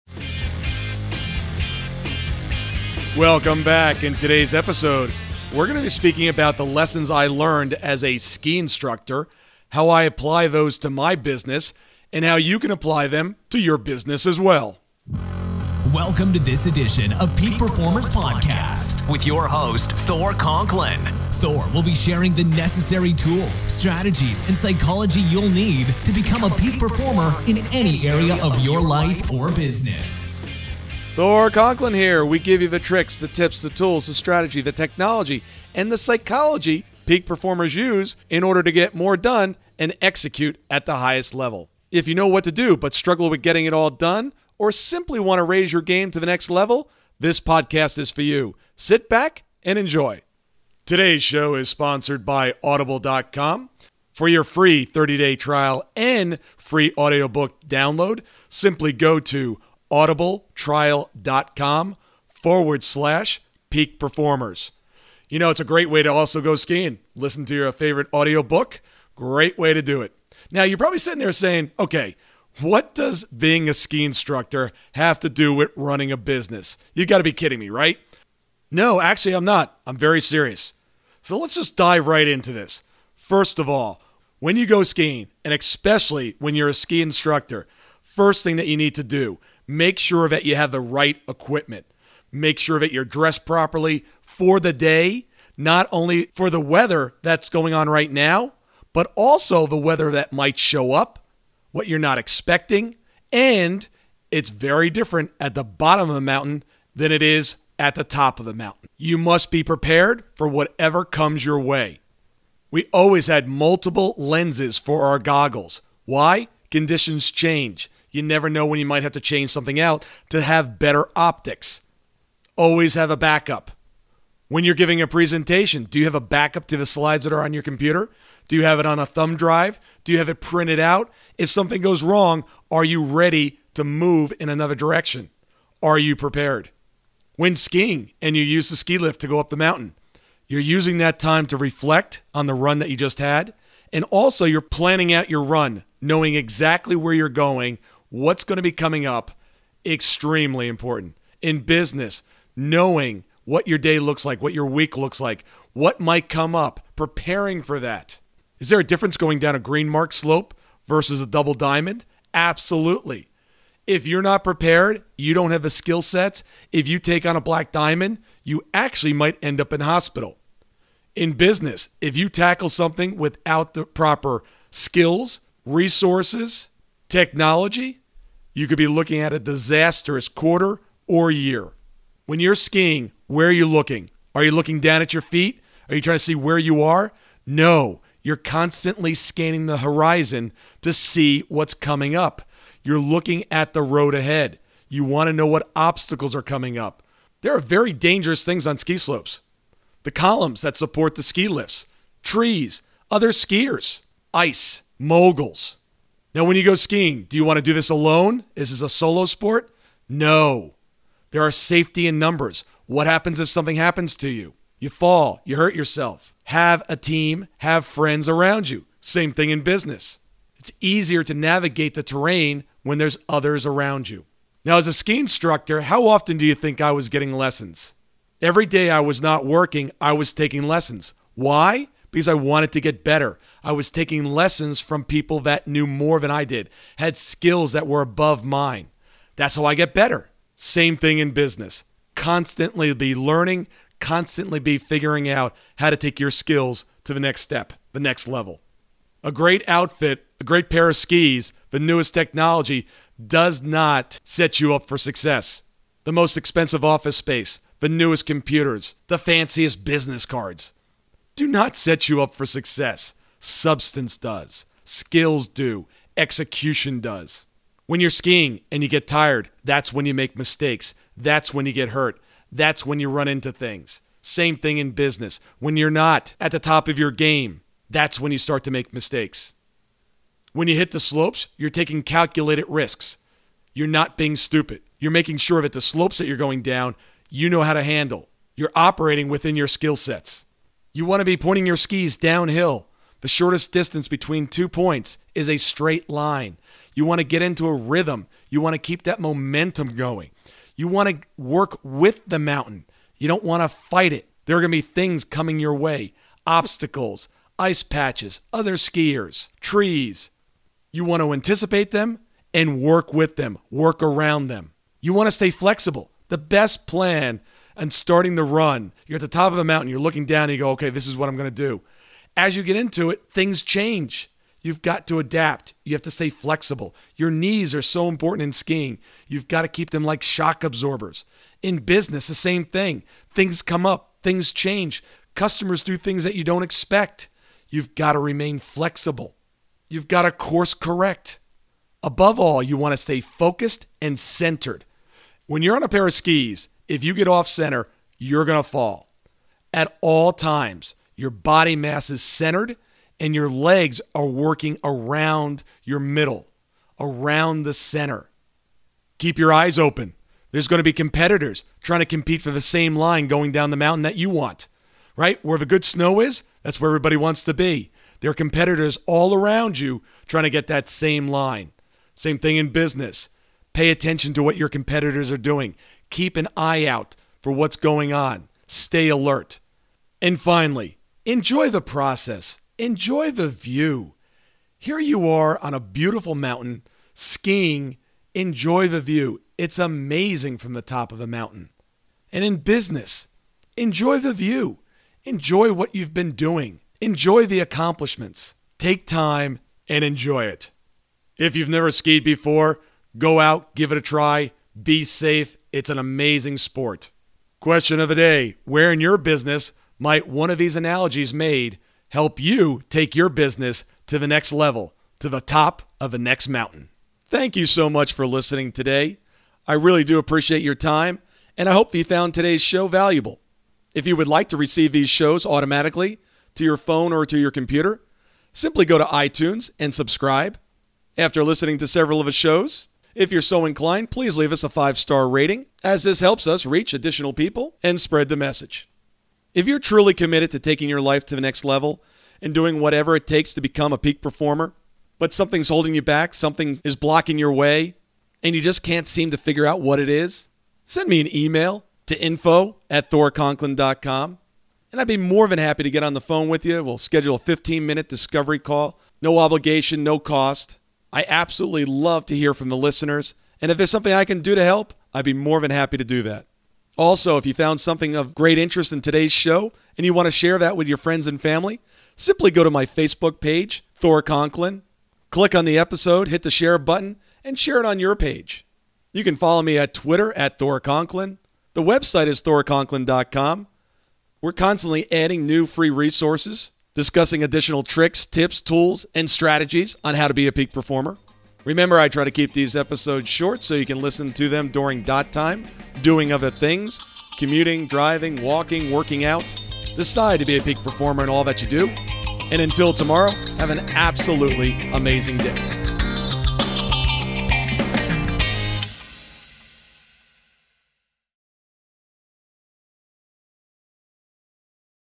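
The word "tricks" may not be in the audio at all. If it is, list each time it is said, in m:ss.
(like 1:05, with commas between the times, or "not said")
0:32, 8:07.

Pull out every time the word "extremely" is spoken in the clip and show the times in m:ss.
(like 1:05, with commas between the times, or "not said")
2:29.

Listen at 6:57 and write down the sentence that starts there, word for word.
Thank you so much for listening today.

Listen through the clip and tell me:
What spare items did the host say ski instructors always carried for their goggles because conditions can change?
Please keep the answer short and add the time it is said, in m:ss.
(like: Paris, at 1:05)
multiple lenses, at 1:53.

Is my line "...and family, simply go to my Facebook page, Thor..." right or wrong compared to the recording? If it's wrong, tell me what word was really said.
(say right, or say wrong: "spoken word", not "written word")
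right.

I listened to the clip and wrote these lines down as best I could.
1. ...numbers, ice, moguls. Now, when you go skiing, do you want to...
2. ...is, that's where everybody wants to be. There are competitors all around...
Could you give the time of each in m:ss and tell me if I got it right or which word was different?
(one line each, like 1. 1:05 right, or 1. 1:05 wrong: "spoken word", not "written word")
1. 3:23 wrong: "skiers", not "numbers"
2. 6:06 right.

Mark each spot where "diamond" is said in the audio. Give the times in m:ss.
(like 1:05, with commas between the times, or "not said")
2:41, 2:47.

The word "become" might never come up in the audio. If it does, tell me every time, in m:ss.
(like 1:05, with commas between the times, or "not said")
0:26, 7:23.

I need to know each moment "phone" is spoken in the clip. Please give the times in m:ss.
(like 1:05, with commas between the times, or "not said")
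7:06, 7:36.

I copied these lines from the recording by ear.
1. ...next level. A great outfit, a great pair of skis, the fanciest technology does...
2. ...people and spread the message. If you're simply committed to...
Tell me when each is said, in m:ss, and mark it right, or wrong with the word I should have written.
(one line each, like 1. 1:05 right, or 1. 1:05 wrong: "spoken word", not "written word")
1. 4:07 wrong: "newest", not "fanciest"
2. 7:17 wrong: "truly", not "simply".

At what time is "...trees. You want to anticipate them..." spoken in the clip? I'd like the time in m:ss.
5:09.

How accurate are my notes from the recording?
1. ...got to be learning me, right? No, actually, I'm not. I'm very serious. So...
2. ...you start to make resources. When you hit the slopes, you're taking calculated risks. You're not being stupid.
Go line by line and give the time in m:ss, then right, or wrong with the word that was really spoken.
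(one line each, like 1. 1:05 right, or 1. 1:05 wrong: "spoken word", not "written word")
1. 1:17 wrong: "kidding", not "learning"
2. 4:38 wrong: "mistakes", not "resources".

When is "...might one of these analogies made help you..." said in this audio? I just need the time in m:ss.
6:49.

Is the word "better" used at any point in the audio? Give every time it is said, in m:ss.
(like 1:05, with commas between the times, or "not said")
2:00, 3:53, 3:59.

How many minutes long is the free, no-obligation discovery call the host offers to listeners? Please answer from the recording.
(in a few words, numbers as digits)
15.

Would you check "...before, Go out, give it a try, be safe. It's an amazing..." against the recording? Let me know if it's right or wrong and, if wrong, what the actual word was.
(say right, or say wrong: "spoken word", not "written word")
right.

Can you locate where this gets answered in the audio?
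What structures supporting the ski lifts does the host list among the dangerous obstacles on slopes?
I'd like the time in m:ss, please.
3:20.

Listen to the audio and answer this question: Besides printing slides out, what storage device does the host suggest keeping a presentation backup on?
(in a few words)
thumb drive.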